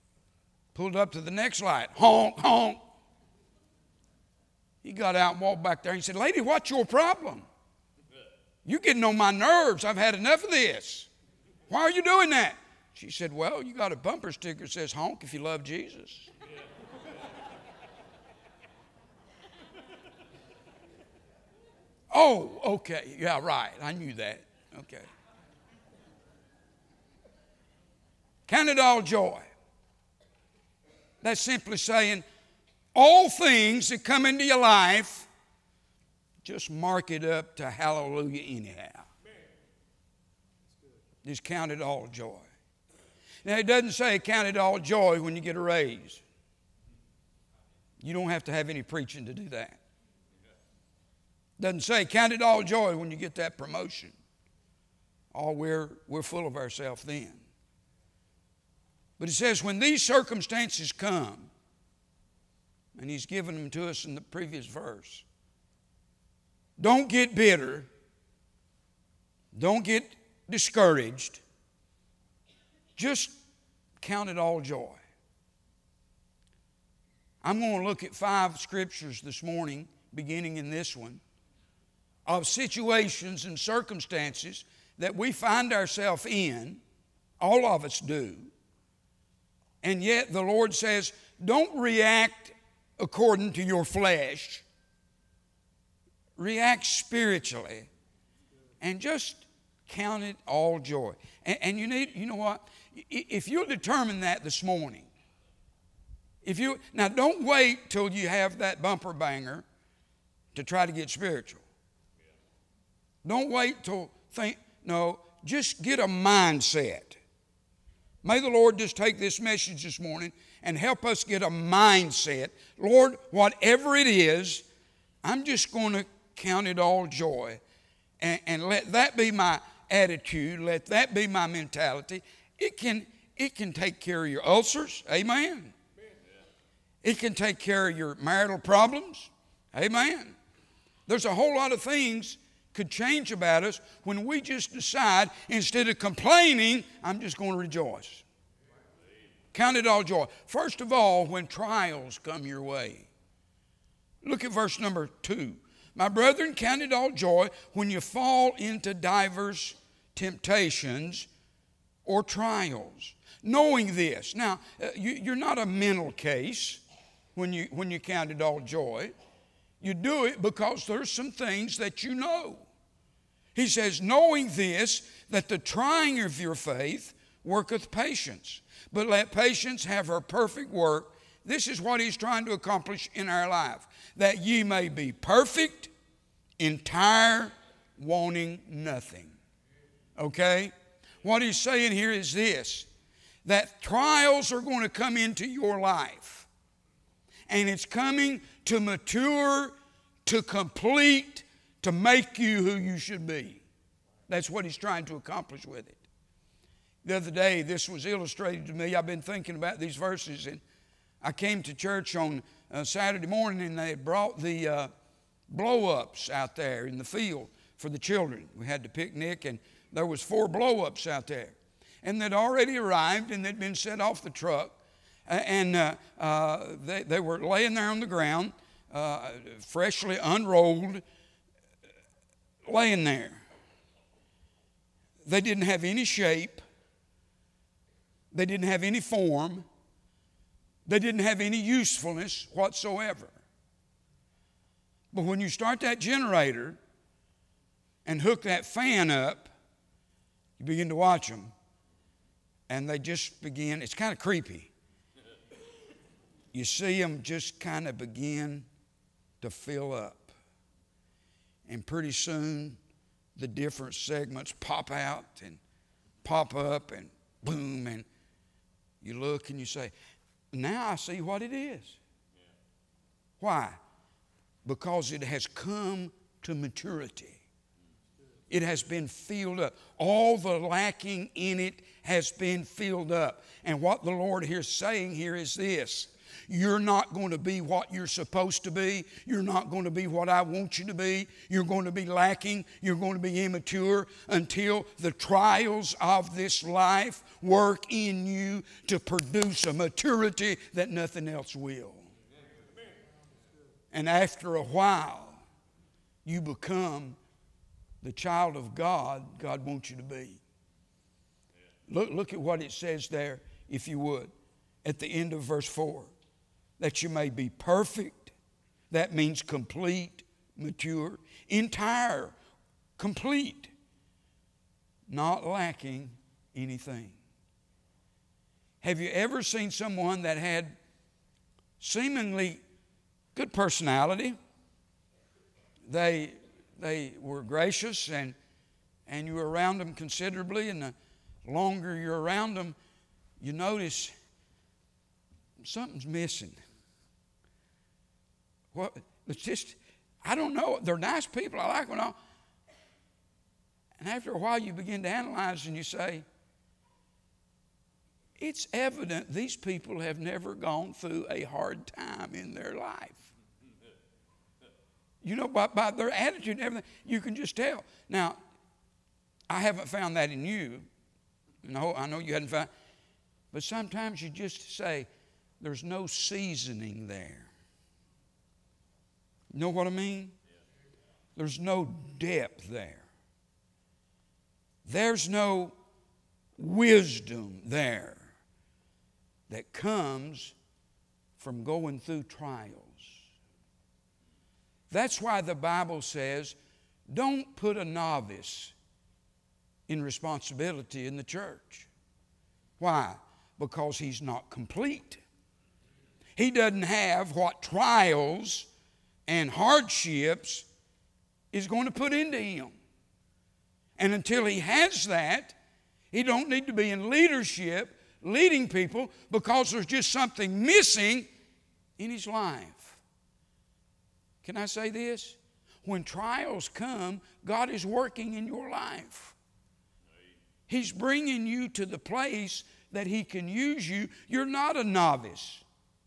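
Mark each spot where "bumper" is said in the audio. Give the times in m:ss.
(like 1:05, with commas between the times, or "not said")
0:13, 1:48.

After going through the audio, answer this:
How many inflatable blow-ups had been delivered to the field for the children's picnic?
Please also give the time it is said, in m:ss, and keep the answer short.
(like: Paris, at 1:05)
4, at 3:40.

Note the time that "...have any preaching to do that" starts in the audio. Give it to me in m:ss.
0:48.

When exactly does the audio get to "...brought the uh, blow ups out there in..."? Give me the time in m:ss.
3:33.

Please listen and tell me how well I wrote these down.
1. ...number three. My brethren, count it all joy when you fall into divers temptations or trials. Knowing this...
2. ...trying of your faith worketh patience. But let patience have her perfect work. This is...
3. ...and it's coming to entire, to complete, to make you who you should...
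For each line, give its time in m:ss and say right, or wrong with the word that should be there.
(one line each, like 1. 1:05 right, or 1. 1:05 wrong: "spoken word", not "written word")
1. 2:34 wrong: "two", not "three"
2. 2:55 right
3. 3:17 wrong: "mature", not "entire".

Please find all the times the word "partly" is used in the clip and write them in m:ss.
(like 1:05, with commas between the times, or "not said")
not said.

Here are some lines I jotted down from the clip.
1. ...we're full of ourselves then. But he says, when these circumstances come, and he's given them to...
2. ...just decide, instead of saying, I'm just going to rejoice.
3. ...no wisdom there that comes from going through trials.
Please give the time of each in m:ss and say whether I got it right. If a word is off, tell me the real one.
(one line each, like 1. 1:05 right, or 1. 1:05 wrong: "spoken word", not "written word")
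1. 0:56 right
2. 2:24 wrong: "complaining", not "saying"
3. 6:25 right.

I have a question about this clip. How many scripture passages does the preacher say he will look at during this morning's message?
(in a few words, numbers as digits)
5.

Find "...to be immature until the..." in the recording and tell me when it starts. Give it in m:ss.
4:53.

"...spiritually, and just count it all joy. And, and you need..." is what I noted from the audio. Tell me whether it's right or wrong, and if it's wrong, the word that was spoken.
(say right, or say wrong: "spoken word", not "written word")
right.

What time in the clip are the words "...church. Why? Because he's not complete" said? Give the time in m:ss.
6:41.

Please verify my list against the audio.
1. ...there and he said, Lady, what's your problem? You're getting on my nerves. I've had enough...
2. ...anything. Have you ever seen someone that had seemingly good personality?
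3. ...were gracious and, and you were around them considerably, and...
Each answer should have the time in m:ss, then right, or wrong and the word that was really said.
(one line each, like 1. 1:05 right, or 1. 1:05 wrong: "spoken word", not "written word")
1. 0:05 right
2. 5:26 right
3. 5:37 right.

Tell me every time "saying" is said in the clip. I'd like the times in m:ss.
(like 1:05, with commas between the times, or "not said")
0:31, 3:11, 4:44.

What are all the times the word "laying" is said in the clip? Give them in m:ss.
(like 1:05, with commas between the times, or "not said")
3:47, 3:52.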